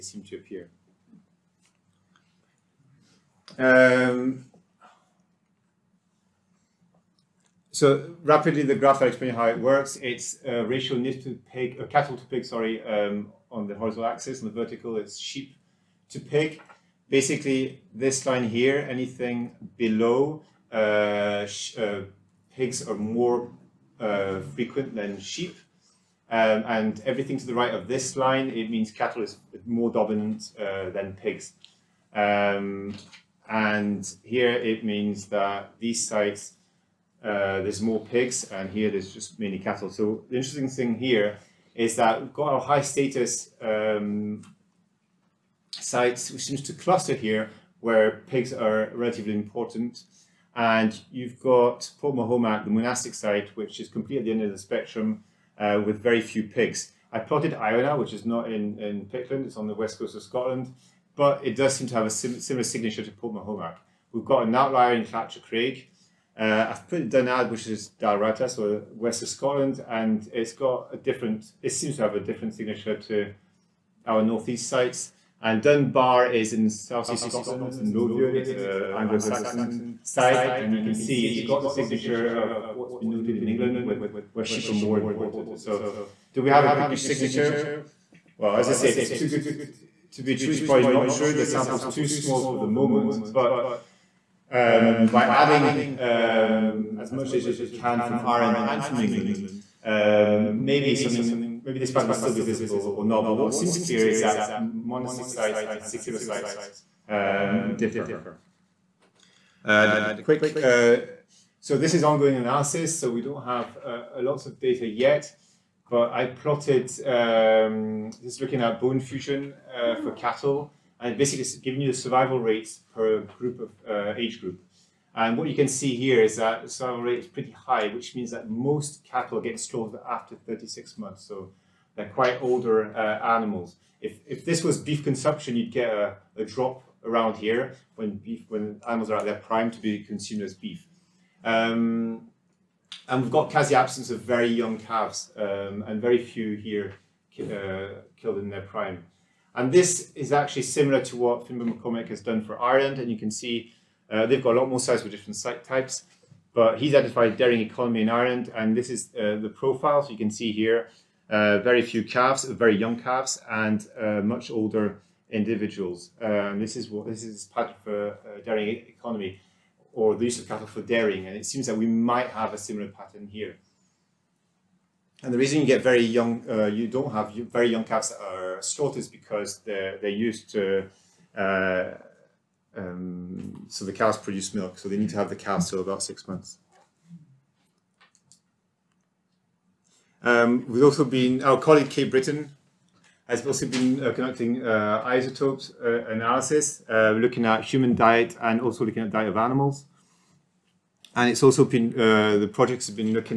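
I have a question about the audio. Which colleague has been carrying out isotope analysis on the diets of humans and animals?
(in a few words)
Kate Britton.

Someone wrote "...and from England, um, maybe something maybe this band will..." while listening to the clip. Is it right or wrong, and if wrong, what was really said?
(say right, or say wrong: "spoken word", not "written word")
right.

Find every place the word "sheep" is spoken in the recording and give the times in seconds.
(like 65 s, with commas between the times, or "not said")
15 s, 25 s, 84 s.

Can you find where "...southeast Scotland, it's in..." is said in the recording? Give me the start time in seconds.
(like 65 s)
76 s.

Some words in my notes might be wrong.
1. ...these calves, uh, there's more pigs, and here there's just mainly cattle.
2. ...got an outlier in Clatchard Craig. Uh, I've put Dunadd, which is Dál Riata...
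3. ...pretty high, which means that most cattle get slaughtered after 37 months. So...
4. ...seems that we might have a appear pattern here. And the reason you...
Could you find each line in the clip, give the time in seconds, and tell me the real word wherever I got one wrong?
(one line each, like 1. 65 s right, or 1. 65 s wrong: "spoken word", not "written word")
1. 35 s wrong: "sites", not "calves"
2. 64 s right
3. 127 s wrong: "36", not "37"
4. 171 s wrong: "similar", not "appear".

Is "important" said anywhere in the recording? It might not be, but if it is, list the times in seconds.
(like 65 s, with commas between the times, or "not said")
49 s, 84 s.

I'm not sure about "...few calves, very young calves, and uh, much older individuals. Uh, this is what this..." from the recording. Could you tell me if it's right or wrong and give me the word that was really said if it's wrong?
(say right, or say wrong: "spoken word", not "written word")
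right.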